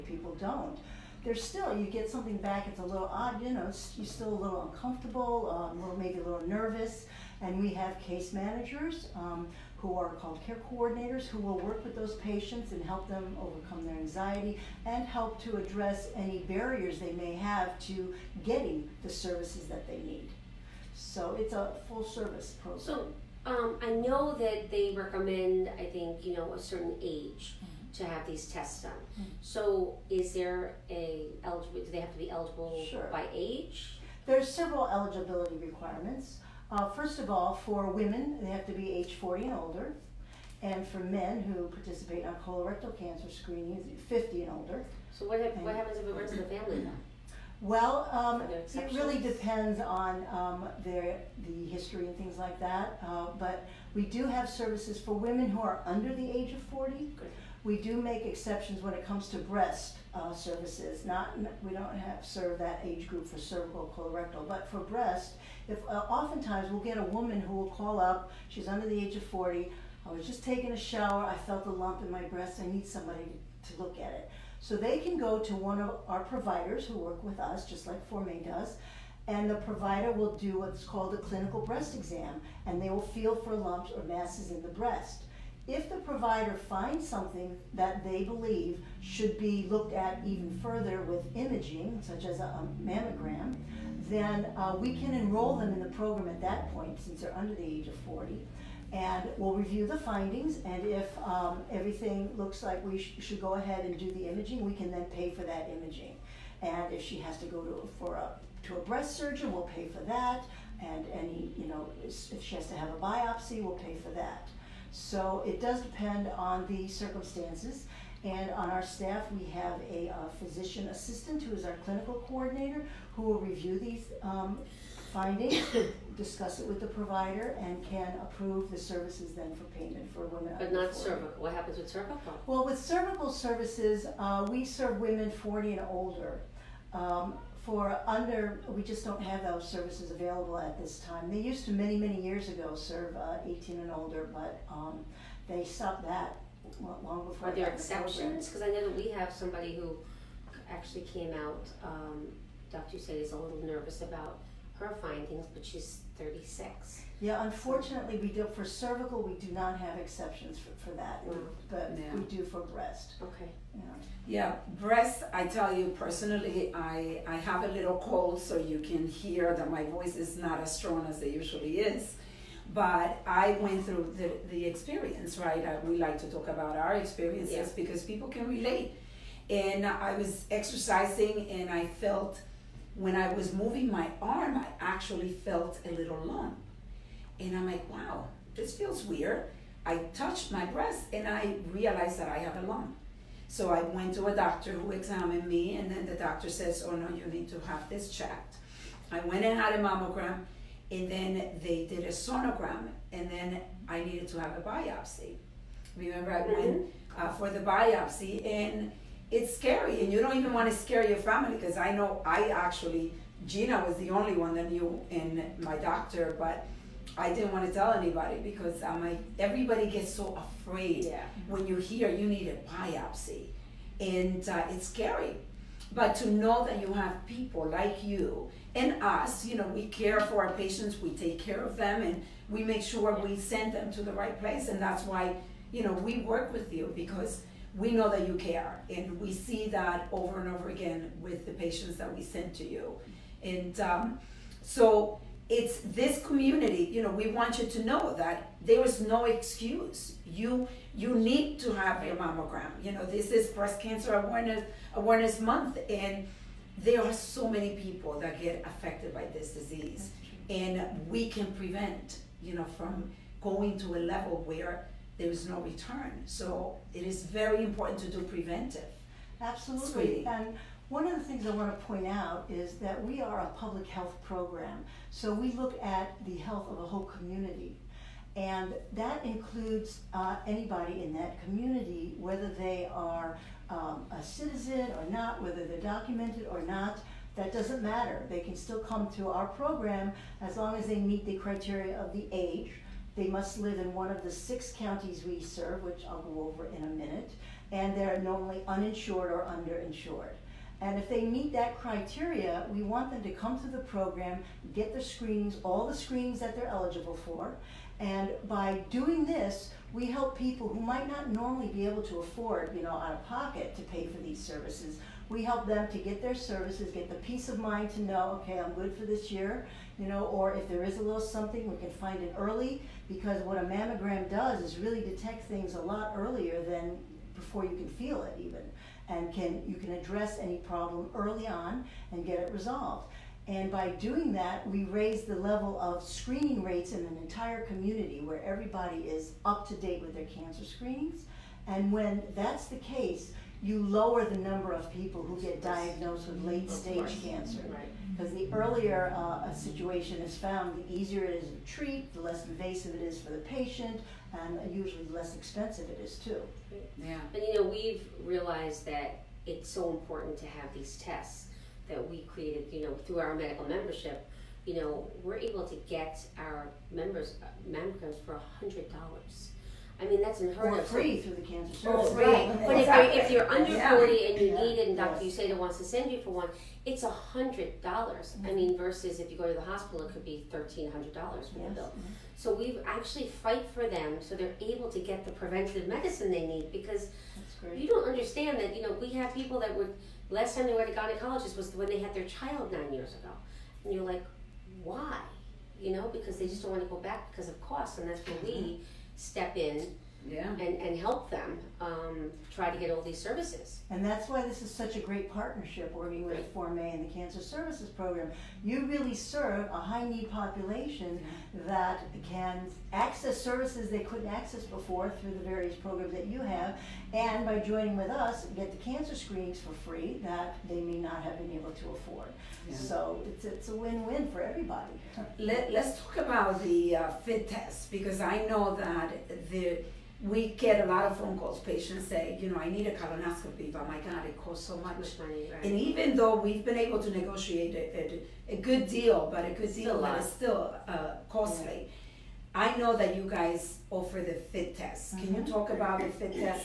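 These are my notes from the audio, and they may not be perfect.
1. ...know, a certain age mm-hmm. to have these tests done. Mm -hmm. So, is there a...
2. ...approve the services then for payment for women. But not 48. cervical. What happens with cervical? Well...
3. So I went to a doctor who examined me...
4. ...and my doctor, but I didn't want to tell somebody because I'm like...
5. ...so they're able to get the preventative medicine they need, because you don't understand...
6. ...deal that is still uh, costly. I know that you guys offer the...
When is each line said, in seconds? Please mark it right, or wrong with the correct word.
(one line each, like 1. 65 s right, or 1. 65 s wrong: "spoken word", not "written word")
1. 26 s right
2. 128 s wrong: "40", not "48"
3. 193 s right
4. 215 s wrong: "anybody", not "somebody"
5. 384 s right
6. 439 s right.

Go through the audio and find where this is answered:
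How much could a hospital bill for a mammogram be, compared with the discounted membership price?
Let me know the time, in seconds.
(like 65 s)
380 s.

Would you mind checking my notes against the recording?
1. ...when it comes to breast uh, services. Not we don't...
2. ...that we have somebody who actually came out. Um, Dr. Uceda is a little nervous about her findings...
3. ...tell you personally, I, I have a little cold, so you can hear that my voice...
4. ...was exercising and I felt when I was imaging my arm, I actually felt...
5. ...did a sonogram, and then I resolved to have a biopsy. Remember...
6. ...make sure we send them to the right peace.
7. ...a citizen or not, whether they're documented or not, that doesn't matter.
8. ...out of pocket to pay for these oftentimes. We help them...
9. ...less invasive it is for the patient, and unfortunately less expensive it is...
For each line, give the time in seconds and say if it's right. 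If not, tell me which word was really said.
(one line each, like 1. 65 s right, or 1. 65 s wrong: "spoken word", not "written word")
1. 58 s right
2. 148 s right
3. 165 s right
4. 180 s wrong: "moving", not "imaging"
5. 201 s wrong: "needed", not "resolved"
6. 232 s wrong: "place", not "peace"
7. 284 s right
8. 312 s wrong: "services", not "oftentimes"
9. 352 s wrong: "usually", not "unfortunately".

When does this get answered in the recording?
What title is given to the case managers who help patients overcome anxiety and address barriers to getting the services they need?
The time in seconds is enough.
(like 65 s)
10 s.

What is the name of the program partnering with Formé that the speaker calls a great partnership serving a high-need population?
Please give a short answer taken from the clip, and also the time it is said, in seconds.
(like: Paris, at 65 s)
Cancer Services Program, at 407 s.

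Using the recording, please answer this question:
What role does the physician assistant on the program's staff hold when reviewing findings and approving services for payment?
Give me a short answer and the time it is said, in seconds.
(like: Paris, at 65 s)
clinical coordinator, at 121 s.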